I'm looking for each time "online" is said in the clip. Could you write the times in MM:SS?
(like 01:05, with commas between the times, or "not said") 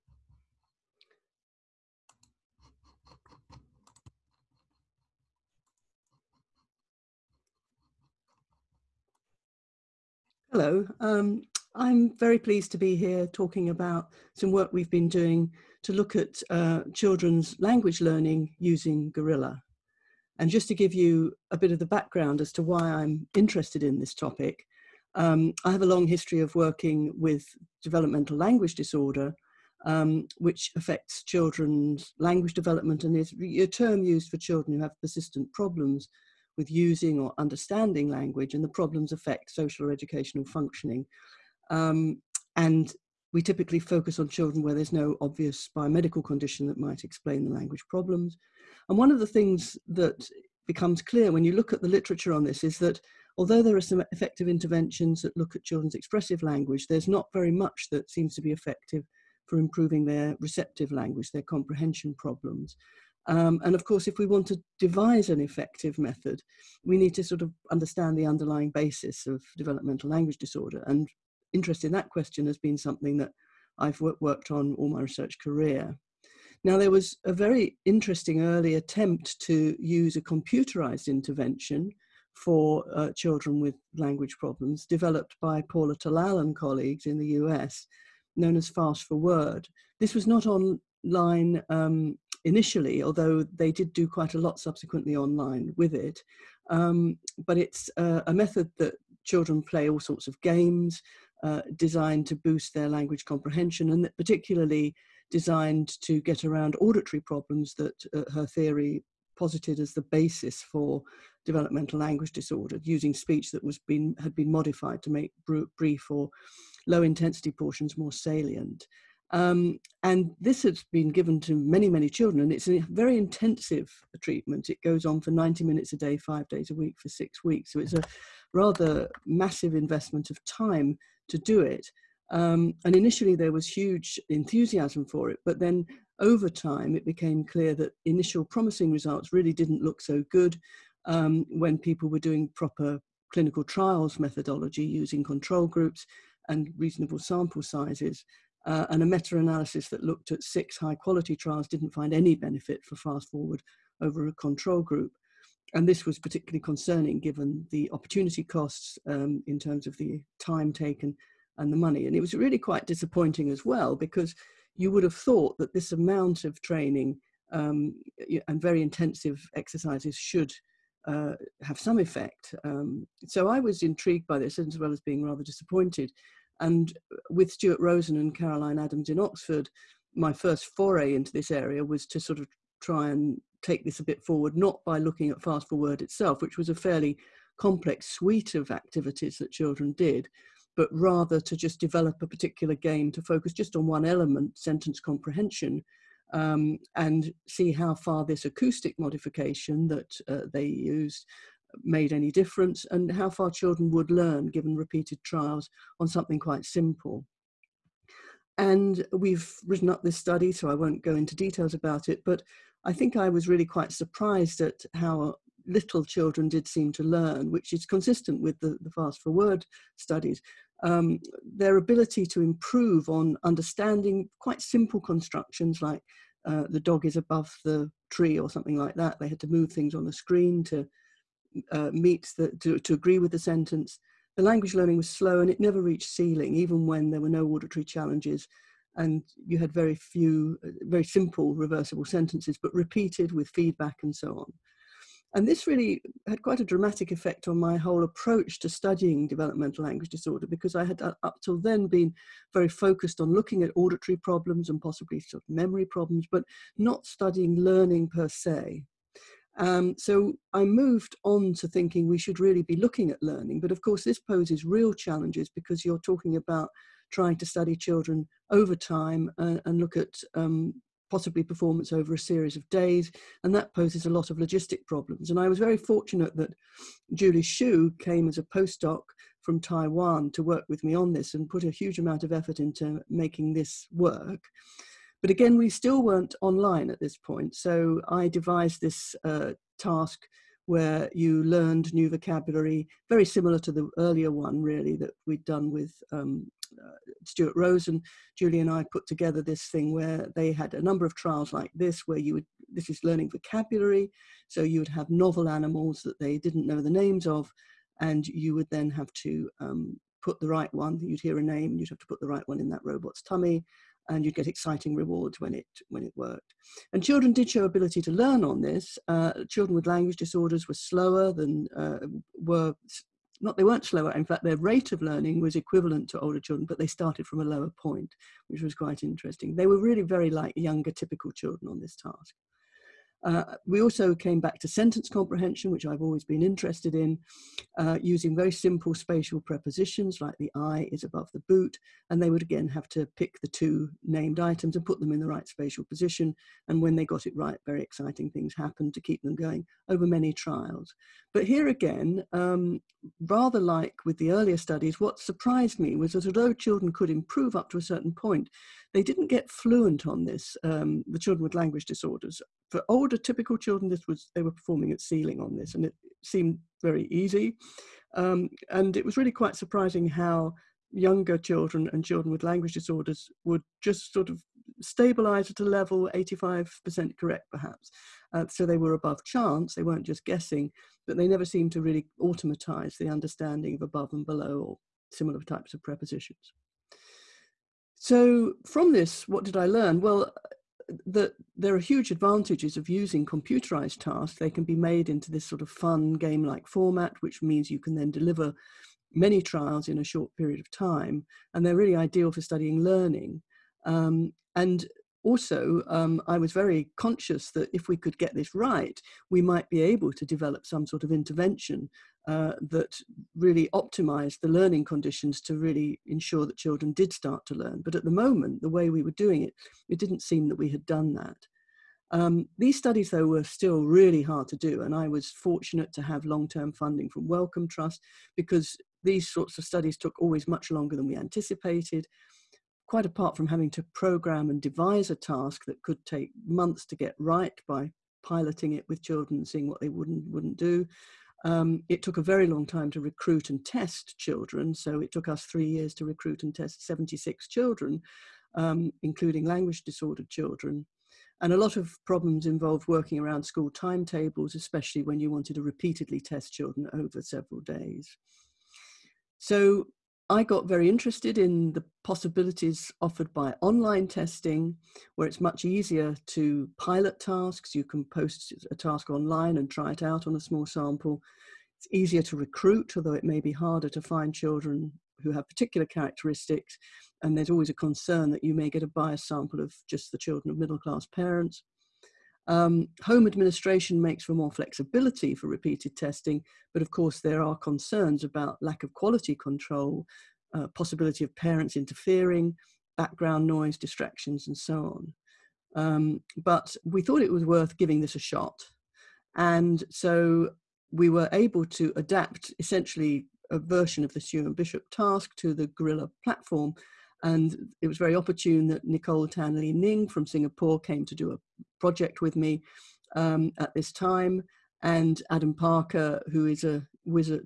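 01:35, 04:46, 07:43, 07:49.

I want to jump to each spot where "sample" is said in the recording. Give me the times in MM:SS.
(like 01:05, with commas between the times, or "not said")
02:27, 07:50, 07:59.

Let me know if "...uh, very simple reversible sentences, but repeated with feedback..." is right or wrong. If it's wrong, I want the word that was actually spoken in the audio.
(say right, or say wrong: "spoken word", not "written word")
right.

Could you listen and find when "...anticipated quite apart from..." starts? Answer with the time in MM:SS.
07:11.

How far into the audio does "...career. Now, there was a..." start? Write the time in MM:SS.
01:15.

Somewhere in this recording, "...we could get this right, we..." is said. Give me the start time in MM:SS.
06:47.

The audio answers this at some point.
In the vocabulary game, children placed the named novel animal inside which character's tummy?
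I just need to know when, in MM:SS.
05:12.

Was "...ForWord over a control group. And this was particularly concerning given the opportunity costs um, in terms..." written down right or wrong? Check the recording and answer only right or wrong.
right.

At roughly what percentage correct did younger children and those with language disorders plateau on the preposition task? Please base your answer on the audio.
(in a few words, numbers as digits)
85%.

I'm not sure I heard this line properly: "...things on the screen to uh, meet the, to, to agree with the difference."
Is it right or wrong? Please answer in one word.
wrong.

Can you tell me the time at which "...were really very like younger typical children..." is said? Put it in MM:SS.
05:29.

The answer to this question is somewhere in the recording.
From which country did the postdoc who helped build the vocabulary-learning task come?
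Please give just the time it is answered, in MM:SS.
04:39.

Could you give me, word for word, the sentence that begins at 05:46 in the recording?
And when they got it right, very exciting things happened to keep them going over many trials.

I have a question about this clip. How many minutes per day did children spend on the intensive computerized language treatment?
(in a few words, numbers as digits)
90.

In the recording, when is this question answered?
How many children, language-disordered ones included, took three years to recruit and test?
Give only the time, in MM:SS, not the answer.
07:26.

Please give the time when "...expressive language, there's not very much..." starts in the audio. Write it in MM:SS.
00:55.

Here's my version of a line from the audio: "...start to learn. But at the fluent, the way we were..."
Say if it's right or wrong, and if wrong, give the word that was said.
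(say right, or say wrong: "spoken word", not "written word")
wrong: "moment", not "fluent".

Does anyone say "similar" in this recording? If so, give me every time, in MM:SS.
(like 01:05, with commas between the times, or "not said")
04:53, 06:25.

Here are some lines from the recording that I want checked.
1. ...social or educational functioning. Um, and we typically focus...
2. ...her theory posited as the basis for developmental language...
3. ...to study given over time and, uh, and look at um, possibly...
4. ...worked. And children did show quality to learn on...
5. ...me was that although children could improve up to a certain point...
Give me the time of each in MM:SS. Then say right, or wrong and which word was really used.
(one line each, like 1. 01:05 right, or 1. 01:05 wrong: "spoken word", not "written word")
1. 00:39 right
2. 01:48 right
3. 04:27 wrong: "children", not "given"
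4. 05:16 wrong: "ability", not "quality"
5. 05:55 right.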